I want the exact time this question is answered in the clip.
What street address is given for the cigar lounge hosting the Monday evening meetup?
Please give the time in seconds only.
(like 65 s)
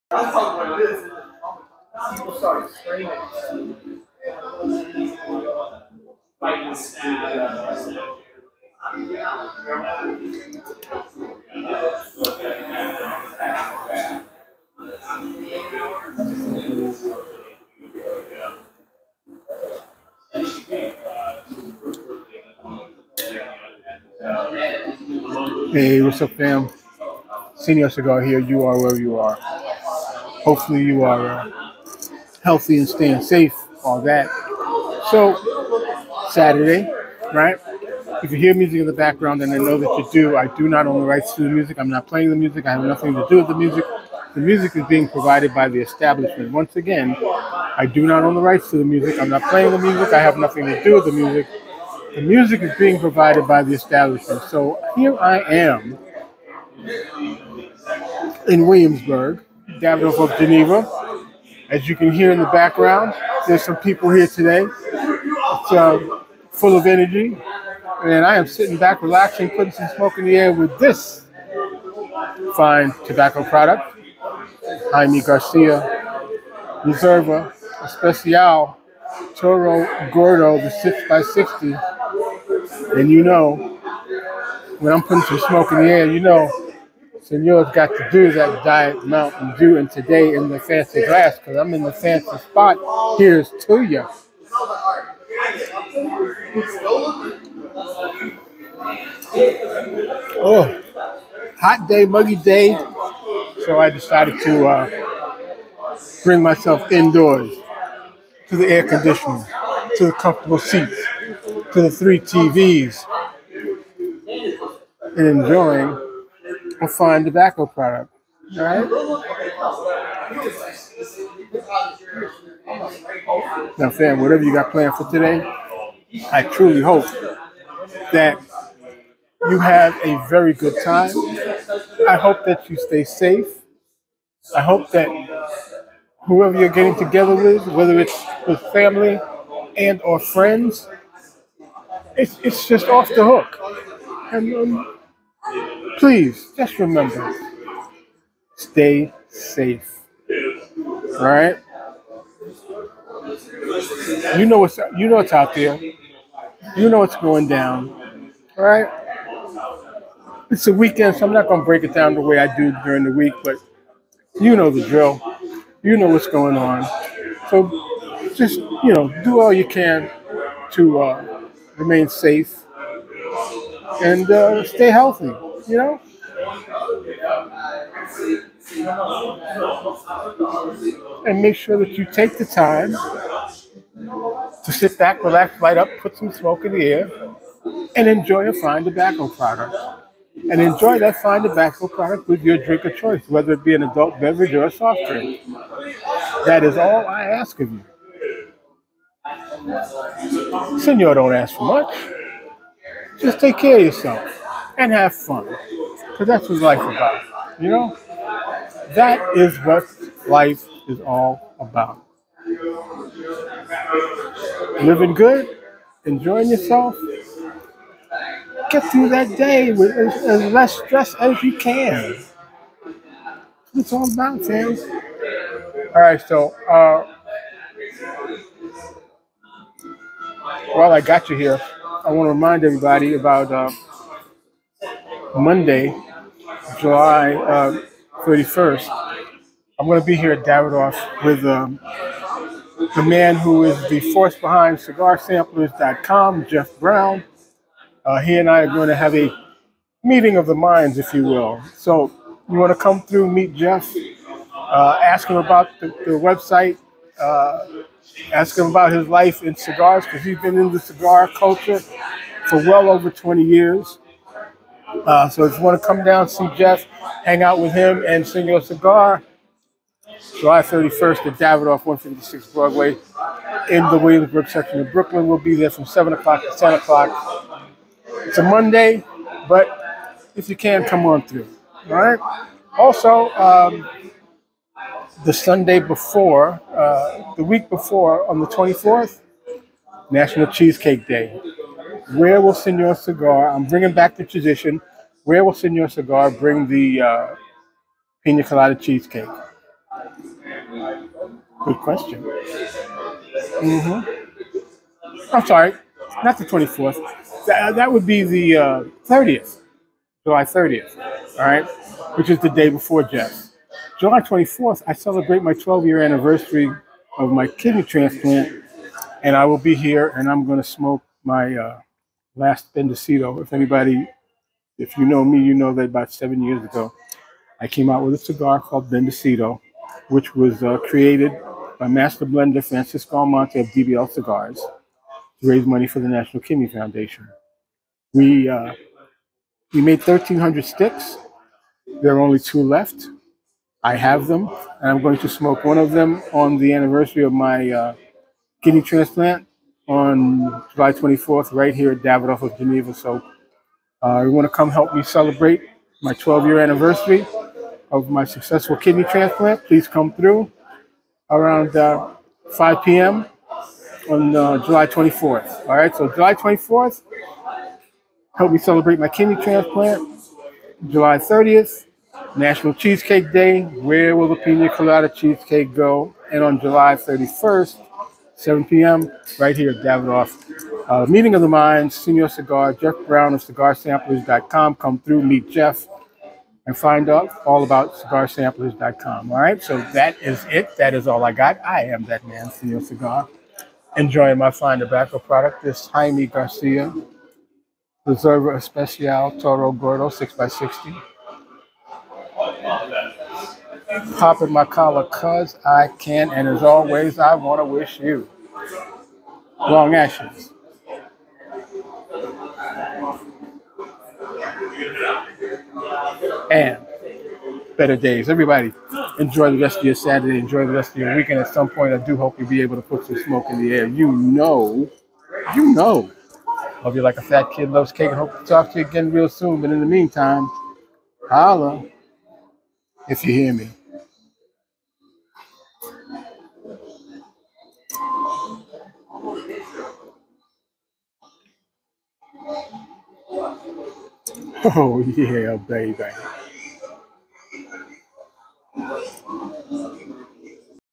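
271 s.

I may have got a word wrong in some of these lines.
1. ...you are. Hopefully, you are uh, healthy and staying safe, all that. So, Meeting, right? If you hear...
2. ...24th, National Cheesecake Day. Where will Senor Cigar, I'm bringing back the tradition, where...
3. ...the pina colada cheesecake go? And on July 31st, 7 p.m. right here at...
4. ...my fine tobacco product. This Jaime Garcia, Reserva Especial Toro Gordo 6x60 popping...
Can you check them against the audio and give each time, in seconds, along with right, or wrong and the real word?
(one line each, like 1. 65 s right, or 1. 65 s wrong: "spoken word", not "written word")
1. 28 s wrong: "Saturday", not "Meeting"
2. 288 s right
3. 374 s right
4. 394 s right.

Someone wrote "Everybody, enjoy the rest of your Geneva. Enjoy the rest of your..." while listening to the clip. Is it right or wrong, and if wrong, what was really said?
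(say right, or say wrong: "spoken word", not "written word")
wrong: "Saturday", not "Geneva".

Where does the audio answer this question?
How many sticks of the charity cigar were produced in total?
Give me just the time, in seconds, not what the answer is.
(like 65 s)
339 s.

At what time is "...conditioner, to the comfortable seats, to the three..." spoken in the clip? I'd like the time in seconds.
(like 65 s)
108 s.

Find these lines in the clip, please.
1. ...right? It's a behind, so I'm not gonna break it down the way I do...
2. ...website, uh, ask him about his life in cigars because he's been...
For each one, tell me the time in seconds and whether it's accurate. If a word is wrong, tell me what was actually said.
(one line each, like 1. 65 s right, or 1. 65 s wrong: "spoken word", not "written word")
1. 158 s wrong: "weekend", not "behind"
2. 256 s right.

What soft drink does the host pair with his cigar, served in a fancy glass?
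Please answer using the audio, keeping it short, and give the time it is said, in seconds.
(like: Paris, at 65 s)
Diet Mountain Dew, at 88 s.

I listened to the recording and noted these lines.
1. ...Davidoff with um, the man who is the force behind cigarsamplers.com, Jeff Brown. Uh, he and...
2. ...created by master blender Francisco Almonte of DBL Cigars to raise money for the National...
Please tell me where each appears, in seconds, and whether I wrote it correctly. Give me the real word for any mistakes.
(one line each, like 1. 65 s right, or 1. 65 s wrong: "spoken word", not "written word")
1. 240 s right
2. 330 s right.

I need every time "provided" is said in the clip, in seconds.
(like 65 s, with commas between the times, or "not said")
45 s, 52 s.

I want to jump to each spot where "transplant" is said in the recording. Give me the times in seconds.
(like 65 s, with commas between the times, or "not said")
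317 s, 348 s, 359 s, 369 s.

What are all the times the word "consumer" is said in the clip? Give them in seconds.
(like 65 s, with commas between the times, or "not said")
not said.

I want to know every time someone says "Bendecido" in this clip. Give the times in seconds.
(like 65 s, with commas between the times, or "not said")
322 s, 328 s.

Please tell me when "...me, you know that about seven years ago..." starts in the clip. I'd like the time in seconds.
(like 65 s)
325 s.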